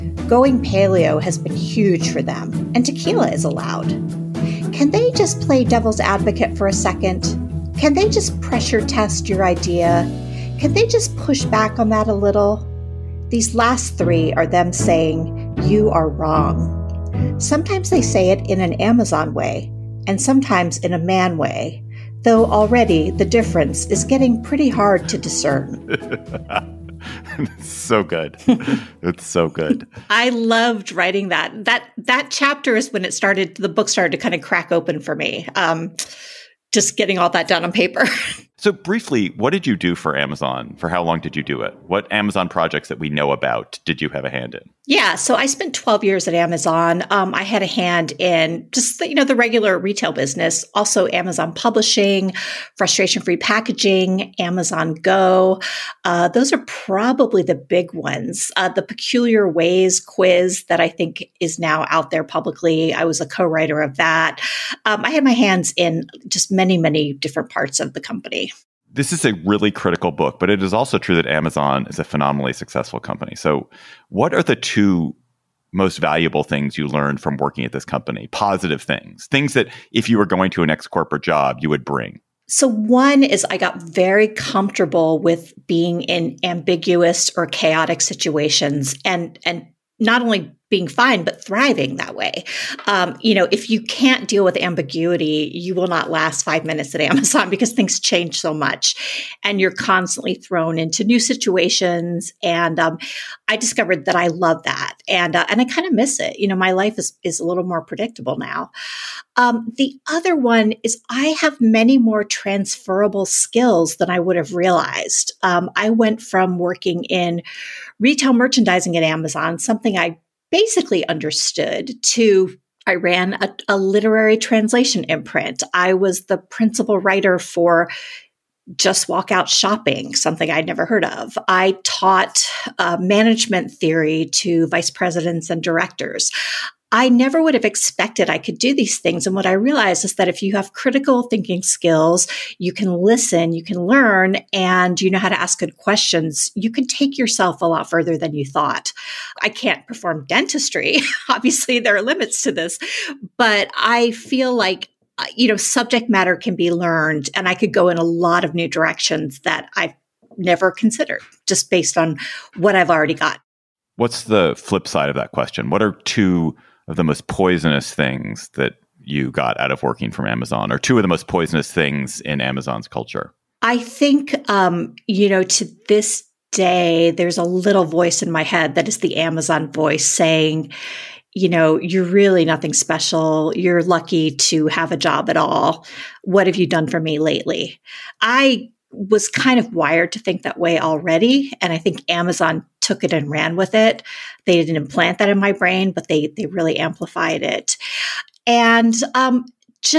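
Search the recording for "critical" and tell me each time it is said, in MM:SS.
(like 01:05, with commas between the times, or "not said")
01:09, 02:20.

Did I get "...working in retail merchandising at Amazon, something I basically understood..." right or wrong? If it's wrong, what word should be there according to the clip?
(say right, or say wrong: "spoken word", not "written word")
right.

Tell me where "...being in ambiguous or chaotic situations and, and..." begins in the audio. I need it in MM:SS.
01:25.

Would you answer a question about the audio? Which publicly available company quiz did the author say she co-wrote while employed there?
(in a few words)
Peculiar Ways quiz.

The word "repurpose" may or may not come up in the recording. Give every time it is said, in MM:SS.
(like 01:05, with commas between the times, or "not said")
not said.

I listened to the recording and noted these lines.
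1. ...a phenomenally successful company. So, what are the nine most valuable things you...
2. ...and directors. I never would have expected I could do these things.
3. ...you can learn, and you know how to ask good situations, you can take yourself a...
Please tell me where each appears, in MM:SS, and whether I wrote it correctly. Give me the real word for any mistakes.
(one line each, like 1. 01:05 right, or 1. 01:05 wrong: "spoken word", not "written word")
1. 01:11 wrong: "two", not "nine"
2. 02:15 right
3. 02:23 wrong: "questions", not "situations".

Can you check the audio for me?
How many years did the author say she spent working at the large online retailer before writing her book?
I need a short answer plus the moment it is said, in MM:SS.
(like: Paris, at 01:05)
12, at 00:45.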